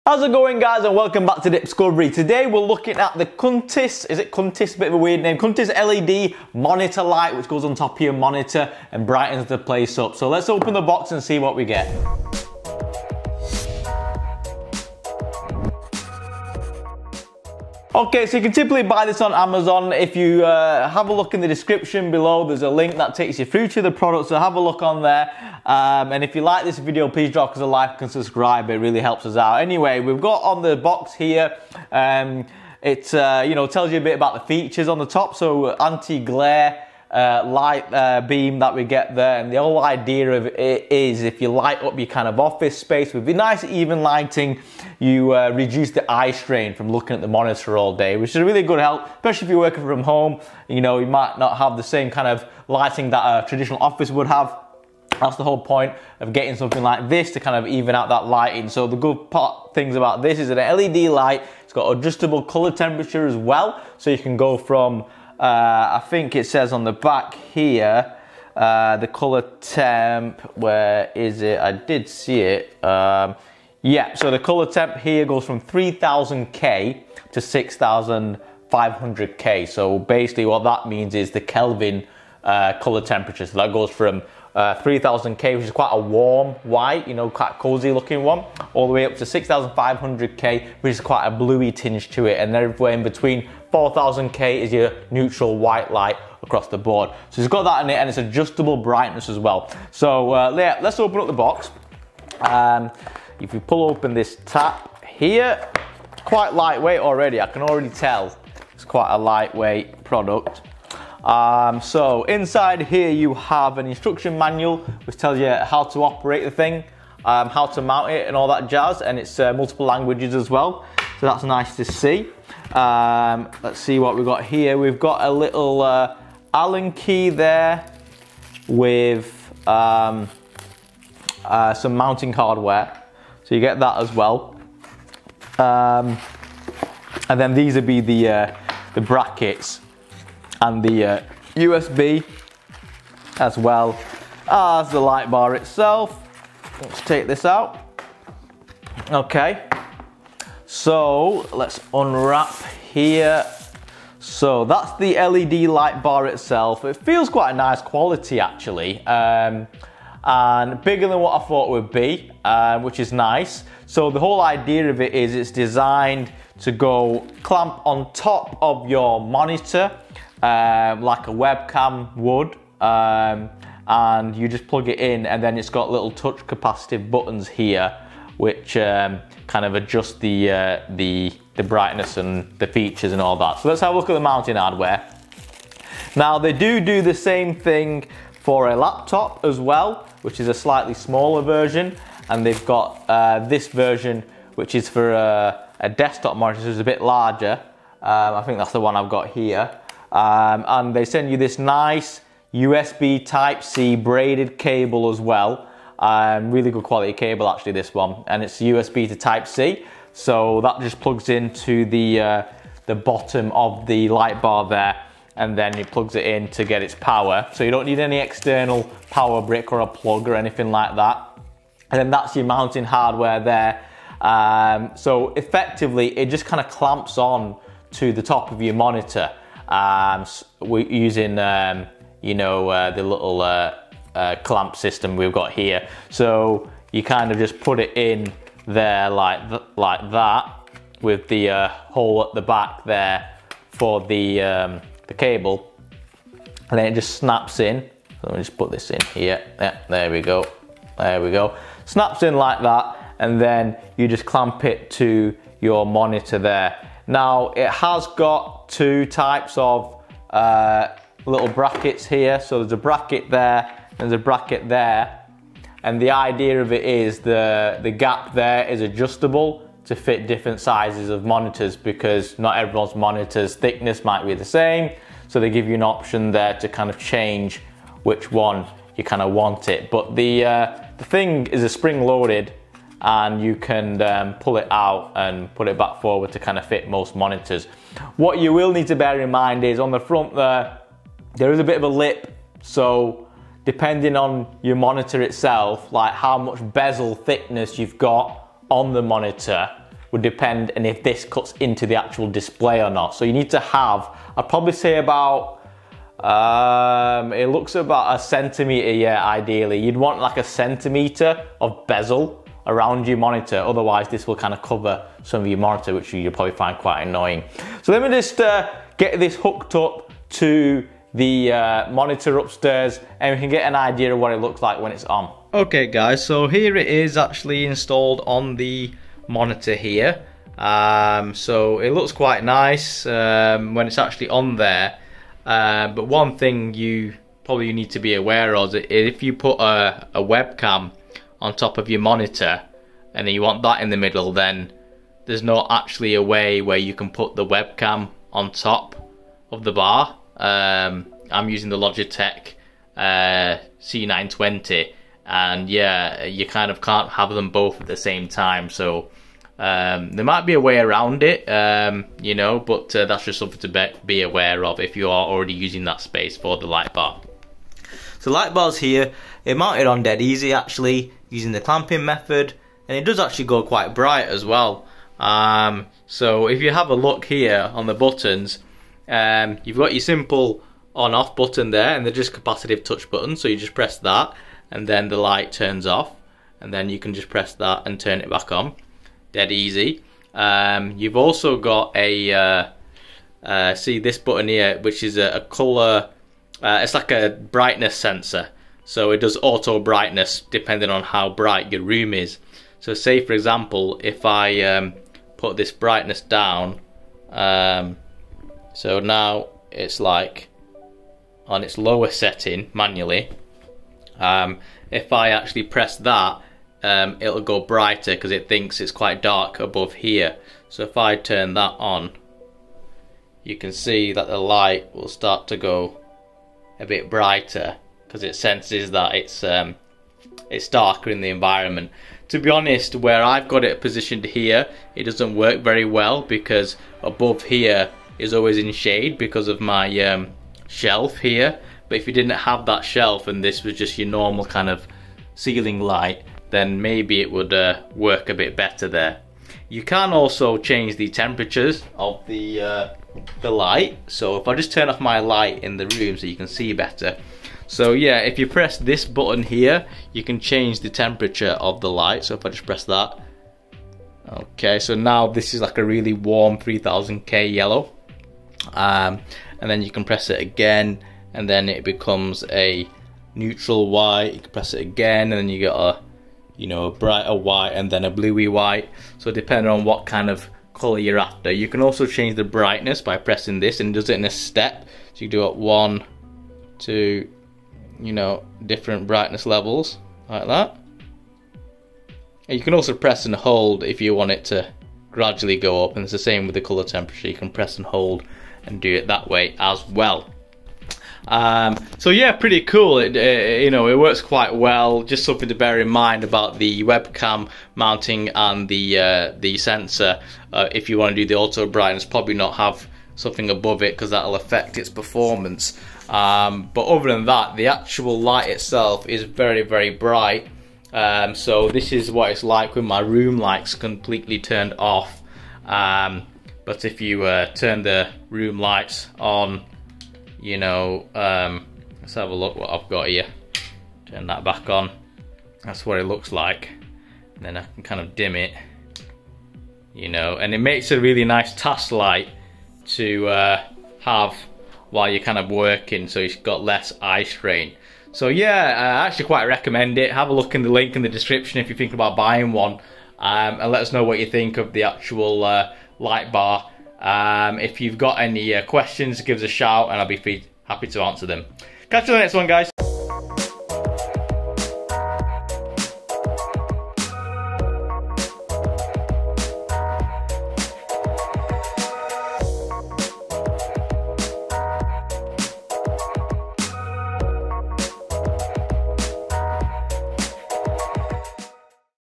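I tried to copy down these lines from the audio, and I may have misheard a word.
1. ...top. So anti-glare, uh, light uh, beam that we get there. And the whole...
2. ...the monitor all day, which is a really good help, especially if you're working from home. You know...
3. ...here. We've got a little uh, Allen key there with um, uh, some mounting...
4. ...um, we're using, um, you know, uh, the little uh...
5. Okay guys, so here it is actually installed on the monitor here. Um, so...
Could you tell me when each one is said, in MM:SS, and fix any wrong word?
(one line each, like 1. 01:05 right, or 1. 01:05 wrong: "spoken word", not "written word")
1. 00:35 right
2. 00:47 right
3. 02:04 right
4. 03:49 right
5. 05:25 right.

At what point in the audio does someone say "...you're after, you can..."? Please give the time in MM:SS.
08:00.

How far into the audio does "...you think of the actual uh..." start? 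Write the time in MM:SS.
09:14.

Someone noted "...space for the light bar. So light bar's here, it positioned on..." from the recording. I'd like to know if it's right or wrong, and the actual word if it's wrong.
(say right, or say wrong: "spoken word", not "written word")
wrong: "mounted", not "positioned".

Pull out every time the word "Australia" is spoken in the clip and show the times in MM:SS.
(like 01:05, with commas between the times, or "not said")
not said.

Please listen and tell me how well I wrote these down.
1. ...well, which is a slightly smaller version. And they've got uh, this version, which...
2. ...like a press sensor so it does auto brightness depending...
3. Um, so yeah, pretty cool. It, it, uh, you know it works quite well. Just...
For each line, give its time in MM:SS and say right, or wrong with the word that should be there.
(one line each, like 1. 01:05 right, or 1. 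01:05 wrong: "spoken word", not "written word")
1. 03:09 right
2. 06:36 wrong: "brightness", not "press"
3. 08:21 right.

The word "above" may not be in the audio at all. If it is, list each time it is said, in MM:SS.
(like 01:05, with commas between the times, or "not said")
06:59, 07:17, 08:33.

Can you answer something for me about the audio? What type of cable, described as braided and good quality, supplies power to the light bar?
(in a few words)
USB Type-C.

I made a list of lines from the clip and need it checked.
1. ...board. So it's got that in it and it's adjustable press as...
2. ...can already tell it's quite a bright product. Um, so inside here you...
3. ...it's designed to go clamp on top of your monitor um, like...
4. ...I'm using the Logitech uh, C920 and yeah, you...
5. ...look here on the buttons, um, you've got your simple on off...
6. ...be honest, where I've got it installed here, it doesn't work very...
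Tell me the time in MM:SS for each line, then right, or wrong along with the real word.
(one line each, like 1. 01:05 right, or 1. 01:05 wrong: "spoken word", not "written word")
1. 01:36 wrong: "brightness", not "press"
2. 01:47 wrong: "lightweight", not "bright"
3. 02:45 right
4. 05:51 right
5. 06:16 right
6. 07:12 wrong: "positioned", not "installed".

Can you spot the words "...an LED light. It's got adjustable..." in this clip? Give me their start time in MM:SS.
01:00.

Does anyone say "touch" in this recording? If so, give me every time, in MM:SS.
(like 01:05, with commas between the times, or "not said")
02:56, 06:22.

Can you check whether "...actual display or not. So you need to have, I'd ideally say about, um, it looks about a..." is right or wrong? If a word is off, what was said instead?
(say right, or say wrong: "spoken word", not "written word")
wrong: "probably", not "ideally".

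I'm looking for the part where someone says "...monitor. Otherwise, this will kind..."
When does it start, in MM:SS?
05:13.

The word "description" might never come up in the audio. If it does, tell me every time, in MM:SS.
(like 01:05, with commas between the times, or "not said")
00:21, 09:11.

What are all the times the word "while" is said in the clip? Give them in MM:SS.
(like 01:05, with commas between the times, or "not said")
09:04.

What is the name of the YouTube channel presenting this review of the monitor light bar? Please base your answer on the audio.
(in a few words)
Dipscovery.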